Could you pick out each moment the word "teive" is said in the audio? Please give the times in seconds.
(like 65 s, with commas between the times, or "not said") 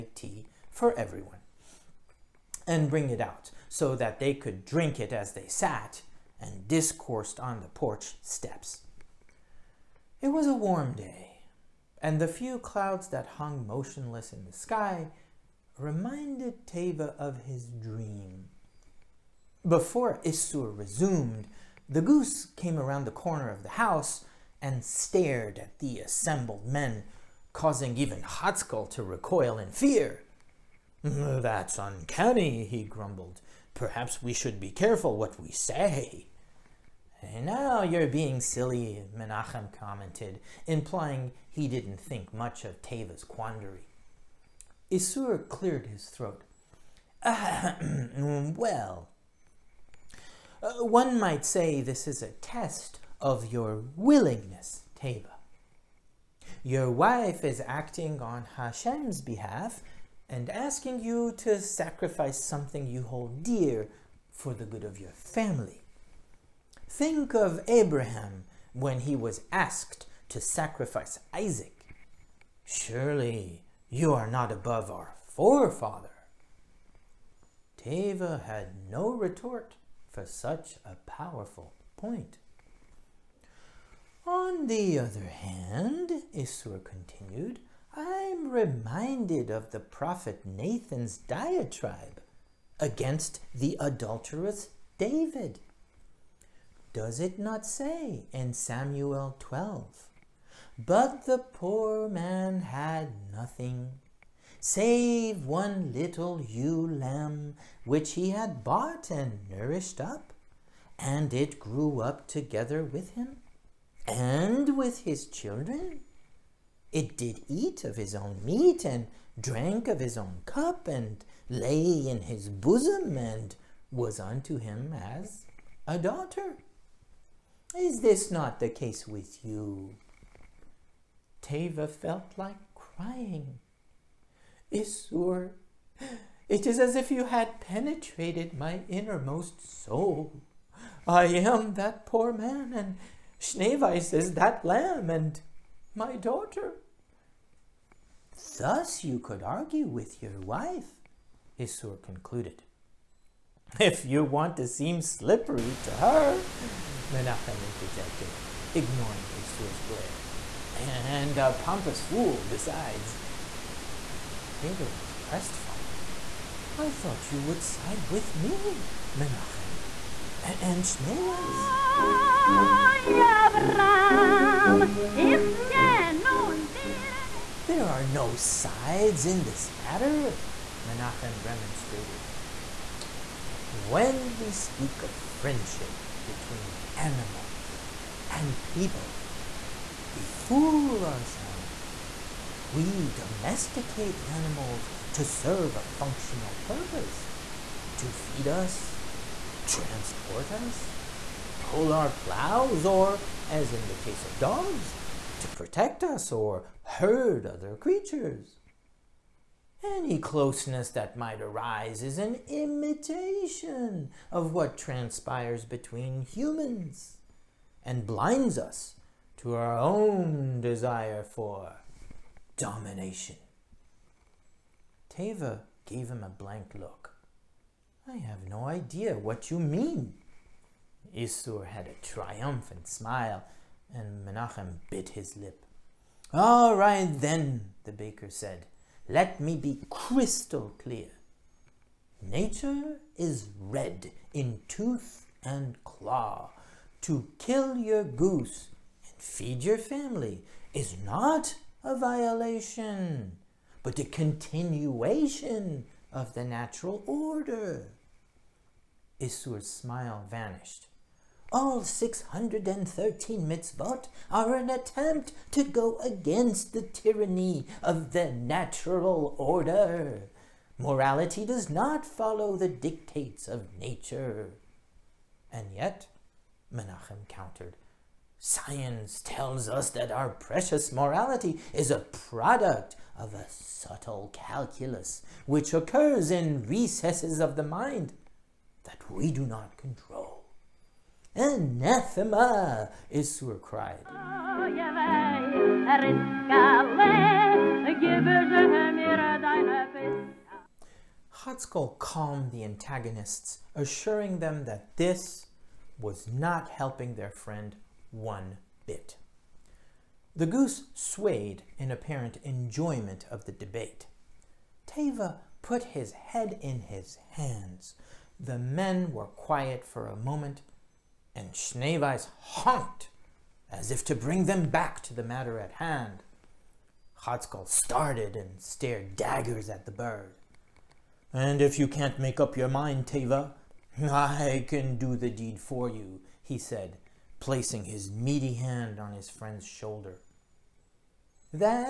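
16 s, 54 s, 77 s, 131 s, 164 s, 225 s, 314 s, 333 s.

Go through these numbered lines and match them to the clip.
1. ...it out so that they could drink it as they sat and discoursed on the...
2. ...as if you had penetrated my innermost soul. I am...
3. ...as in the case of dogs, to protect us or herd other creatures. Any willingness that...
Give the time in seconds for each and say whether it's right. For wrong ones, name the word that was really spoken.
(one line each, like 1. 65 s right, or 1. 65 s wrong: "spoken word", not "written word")
1. 3 s right
2. 136 s right
3. 203 s wrong: "closeness", not "willingness".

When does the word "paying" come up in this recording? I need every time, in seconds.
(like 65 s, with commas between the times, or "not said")
not said.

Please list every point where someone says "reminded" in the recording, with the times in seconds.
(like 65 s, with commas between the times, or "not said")
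15 s, 88 s.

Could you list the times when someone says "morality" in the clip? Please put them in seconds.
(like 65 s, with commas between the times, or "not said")
270 s, 280 s.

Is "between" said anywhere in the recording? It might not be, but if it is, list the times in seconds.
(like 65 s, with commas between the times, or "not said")
186 s, 215 s.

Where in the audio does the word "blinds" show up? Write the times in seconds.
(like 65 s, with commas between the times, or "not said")
218 s.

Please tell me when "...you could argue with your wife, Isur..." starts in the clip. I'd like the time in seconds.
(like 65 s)
149 s.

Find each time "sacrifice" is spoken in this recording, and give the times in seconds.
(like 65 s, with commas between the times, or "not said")
61 s, 70 s.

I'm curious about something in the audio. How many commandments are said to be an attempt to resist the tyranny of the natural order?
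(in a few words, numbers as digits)
613.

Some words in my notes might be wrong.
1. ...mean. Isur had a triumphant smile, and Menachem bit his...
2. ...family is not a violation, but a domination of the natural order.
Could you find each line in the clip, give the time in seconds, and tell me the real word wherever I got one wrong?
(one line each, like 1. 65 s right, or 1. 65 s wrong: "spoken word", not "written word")
1. 229 s right
2. 249 s wrong: "continuation", not "domination".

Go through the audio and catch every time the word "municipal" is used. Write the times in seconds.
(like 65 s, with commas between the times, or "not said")
not said.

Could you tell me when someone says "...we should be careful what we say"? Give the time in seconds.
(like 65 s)
34 s.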